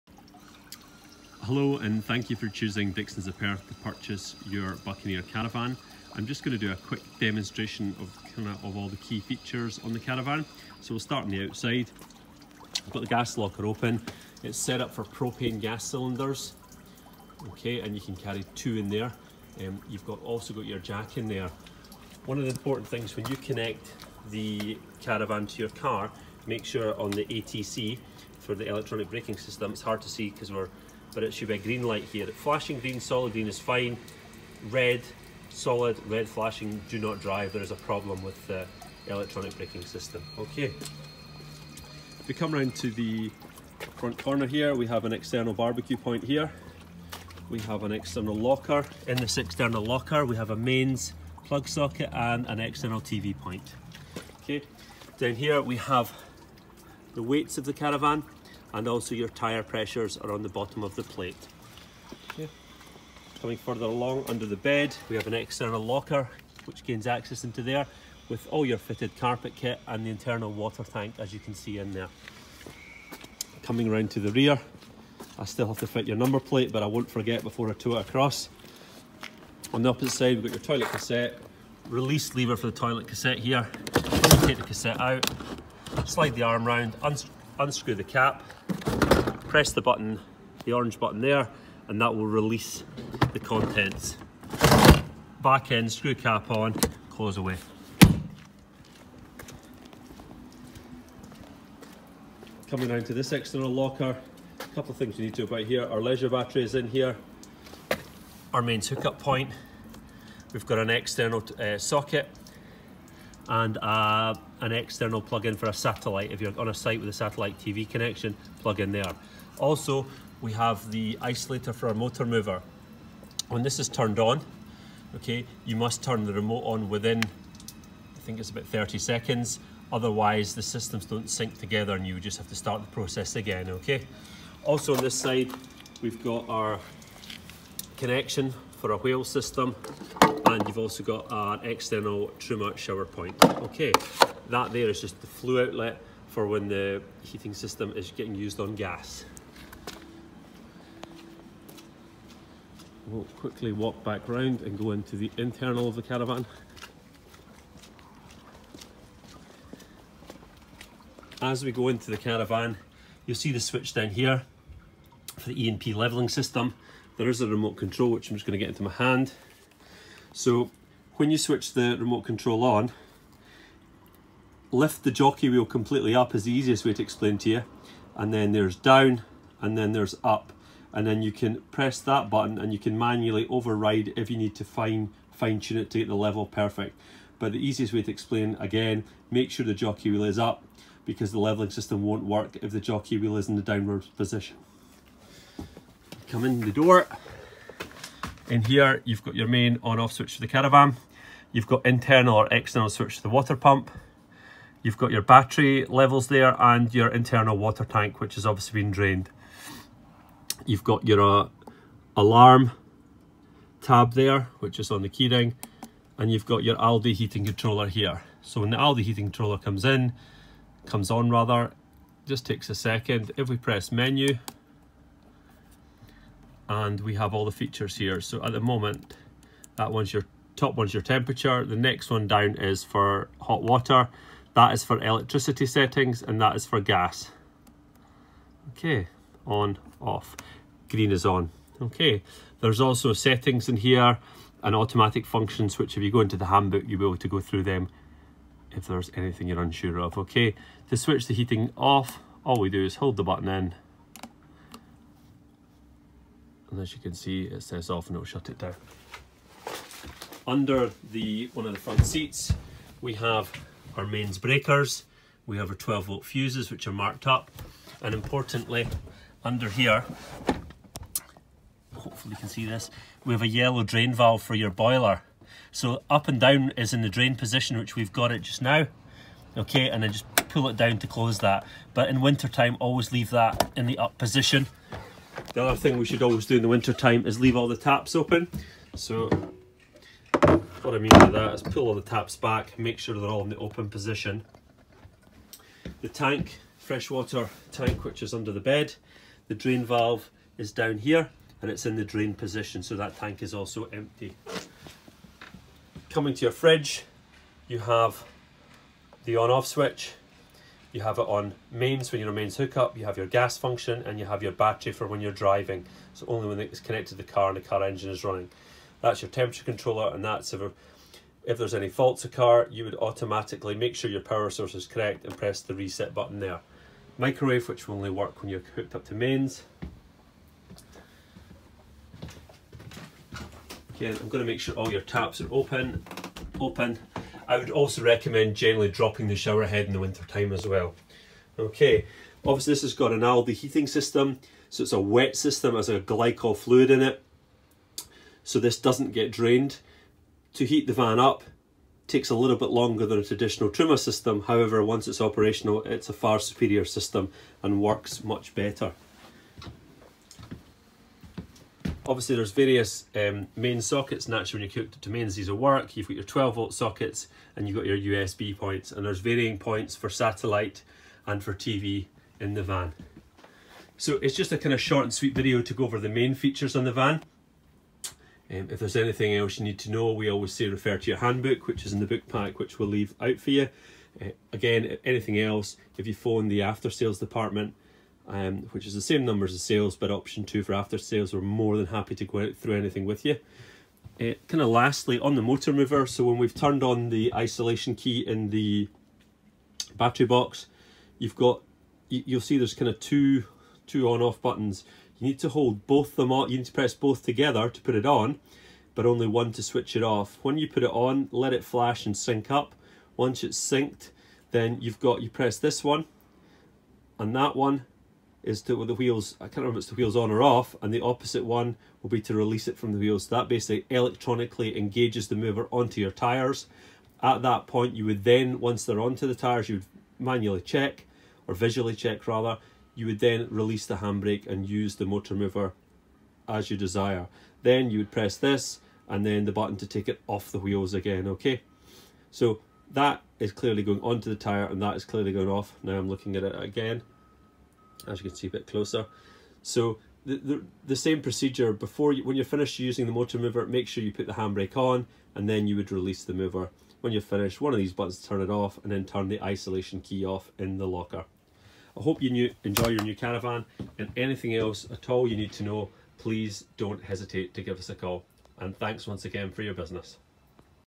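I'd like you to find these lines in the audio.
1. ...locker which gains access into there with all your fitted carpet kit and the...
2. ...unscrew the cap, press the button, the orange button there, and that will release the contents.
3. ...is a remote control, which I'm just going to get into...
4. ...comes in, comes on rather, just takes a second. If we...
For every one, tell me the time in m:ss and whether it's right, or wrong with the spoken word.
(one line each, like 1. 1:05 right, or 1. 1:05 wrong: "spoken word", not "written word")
1. 1:05 right
2. 1:27 right
3. 2:47 right
4. 3:39 right.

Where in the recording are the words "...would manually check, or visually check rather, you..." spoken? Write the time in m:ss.
7:09.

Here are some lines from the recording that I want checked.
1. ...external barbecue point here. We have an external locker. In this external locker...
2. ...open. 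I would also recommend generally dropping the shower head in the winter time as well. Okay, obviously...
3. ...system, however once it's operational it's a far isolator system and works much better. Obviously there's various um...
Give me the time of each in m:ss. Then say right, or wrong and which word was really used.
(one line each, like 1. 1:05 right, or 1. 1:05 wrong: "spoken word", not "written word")
1. 0:45 right
2. 5:36 right
3. 5:53 wrong: "superior", not "isolator".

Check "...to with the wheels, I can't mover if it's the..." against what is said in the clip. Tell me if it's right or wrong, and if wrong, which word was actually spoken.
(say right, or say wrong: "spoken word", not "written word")
wrong: "remember", not "mover".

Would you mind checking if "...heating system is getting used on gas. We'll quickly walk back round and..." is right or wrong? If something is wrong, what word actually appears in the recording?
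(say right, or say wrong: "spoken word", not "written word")
right.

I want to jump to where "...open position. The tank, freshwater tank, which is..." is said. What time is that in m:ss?
4:53.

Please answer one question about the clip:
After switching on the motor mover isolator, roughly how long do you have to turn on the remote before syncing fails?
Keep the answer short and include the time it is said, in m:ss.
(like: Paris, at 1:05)
30 seconds, at 2:08.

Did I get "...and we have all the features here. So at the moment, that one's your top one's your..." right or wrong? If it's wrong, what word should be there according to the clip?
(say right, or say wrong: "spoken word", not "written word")
right.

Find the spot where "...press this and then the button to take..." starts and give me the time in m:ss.
7:18.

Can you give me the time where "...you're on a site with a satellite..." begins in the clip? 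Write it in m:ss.
1:56.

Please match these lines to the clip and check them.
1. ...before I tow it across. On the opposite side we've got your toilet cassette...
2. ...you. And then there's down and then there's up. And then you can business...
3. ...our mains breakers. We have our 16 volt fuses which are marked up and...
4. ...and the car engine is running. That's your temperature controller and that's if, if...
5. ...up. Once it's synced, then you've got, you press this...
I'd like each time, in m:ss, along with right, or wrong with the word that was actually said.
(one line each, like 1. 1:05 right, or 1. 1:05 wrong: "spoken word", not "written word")
1. 1:17 right
2. 2:57 wrong: "press", not "business"
3. 4:23 wrong: "12", not "16"
4. 5:17 right
5. 6:52 right.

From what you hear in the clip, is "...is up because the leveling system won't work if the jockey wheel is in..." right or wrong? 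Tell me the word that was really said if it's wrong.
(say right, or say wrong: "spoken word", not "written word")
right.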